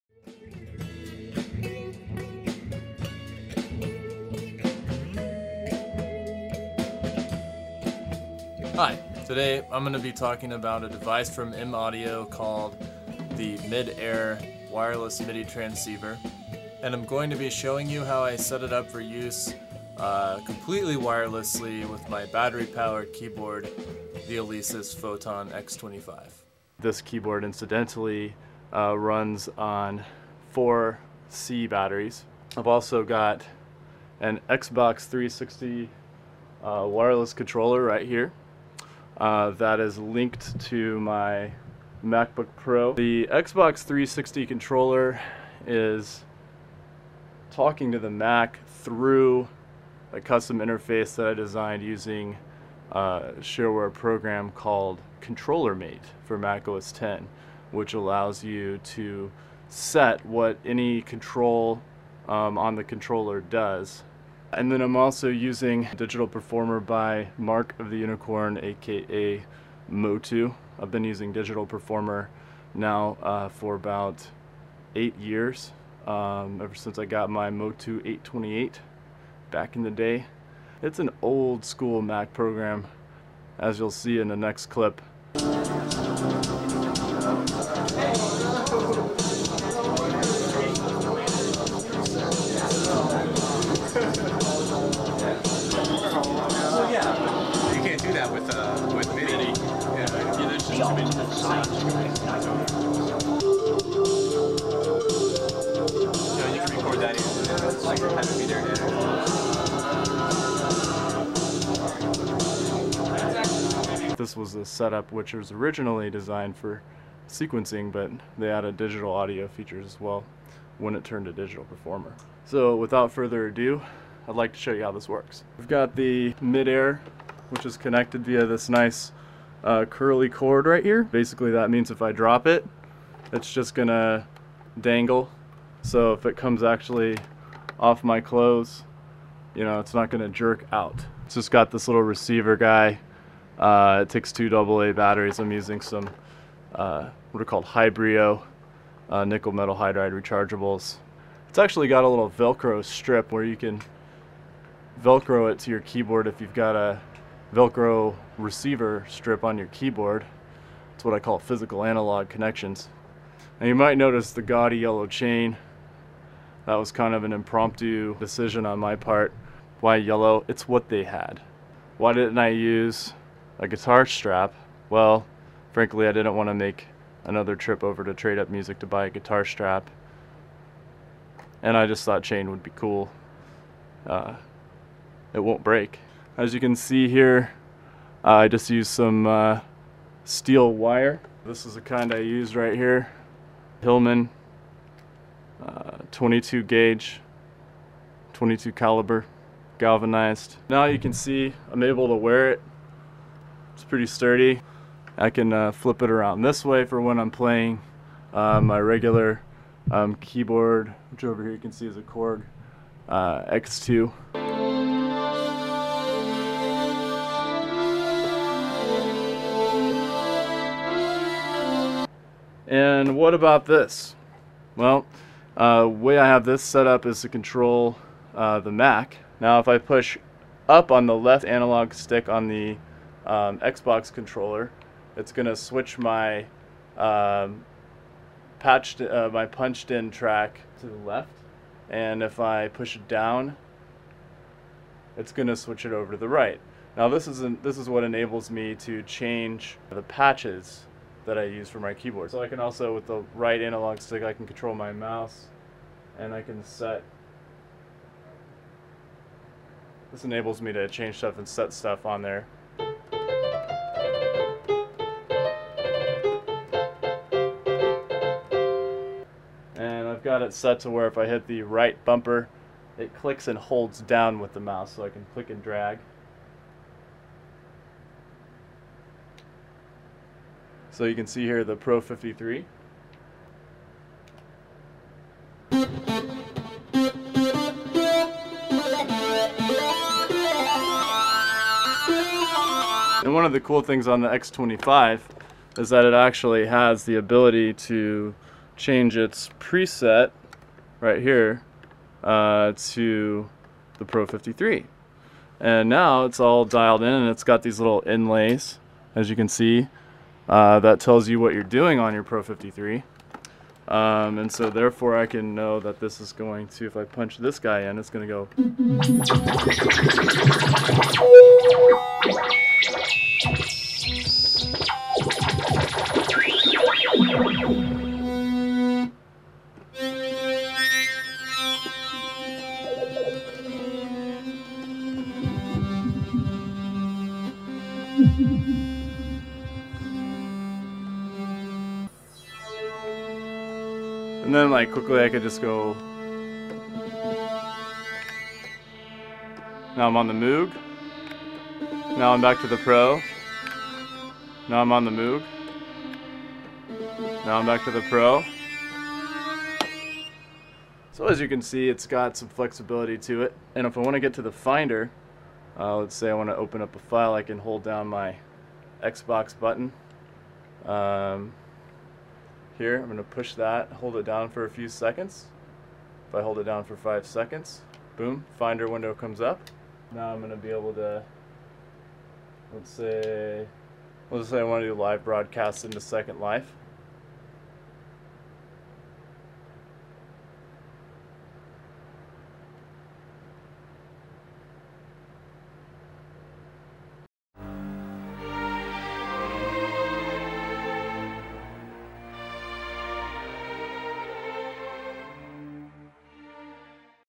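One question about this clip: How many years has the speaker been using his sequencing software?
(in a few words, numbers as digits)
8 years.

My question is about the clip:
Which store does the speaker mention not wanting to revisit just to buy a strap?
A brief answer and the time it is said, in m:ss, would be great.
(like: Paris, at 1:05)
Trade Up Music, at 2:58.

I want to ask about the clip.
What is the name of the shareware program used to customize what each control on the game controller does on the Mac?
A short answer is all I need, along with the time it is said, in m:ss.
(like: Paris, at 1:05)
Controller Mate, at 0:55.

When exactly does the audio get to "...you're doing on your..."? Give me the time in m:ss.
5:11.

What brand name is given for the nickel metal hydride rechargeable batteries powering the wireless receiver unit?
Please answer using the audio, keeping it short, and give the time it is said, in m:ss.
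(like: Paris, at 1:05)
Hybrio, at 2:27.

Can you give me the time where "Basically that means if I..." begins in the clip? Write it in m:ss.
2:11.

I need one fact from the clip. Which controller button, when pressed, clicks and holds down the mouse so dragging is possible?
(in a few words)
right bumper.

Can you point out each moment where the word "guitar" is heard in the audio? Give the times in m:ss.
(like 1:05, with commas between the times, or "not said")
2:53, 2:59.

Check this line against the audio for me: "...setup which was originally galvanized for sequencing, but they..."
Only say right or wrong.
wrong.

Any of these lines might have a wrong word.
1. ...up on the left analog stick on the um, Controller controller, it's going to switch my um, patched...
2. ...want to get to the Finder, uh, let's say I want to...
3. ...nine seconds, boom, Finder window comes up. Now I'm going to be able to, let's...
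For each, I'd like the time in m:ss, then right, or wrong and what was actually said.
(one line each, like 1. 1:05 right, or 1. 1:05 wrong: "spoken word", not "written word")
1. 3:50 wrong: "Xbox", not "Controller"
2. 6:04 right
3. 6:16 wrong: "five", not "nine".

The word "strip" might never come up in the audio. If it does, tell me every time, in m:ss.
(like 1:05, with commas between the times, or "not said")
2:32, 2:39.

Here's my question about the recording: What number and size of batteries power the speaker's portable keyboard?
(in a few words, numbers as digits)
4 C batteries.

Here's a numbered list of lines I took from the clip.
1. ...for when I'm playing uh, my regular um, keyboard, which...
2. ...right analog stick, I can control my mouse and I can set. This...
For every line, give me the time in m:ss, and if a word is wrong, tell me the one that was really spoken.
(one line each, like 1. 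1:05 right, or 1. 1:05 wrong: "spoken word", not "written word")
1. 3:26 right
2. 4:13 right.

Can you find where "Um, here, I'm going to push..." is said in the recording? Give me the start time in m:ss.
6:10.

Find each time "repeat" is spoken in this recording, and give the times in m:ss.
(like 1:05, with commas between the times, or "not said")
not said.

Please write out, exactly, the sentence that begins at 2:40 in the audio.
its what I call physical analog connections.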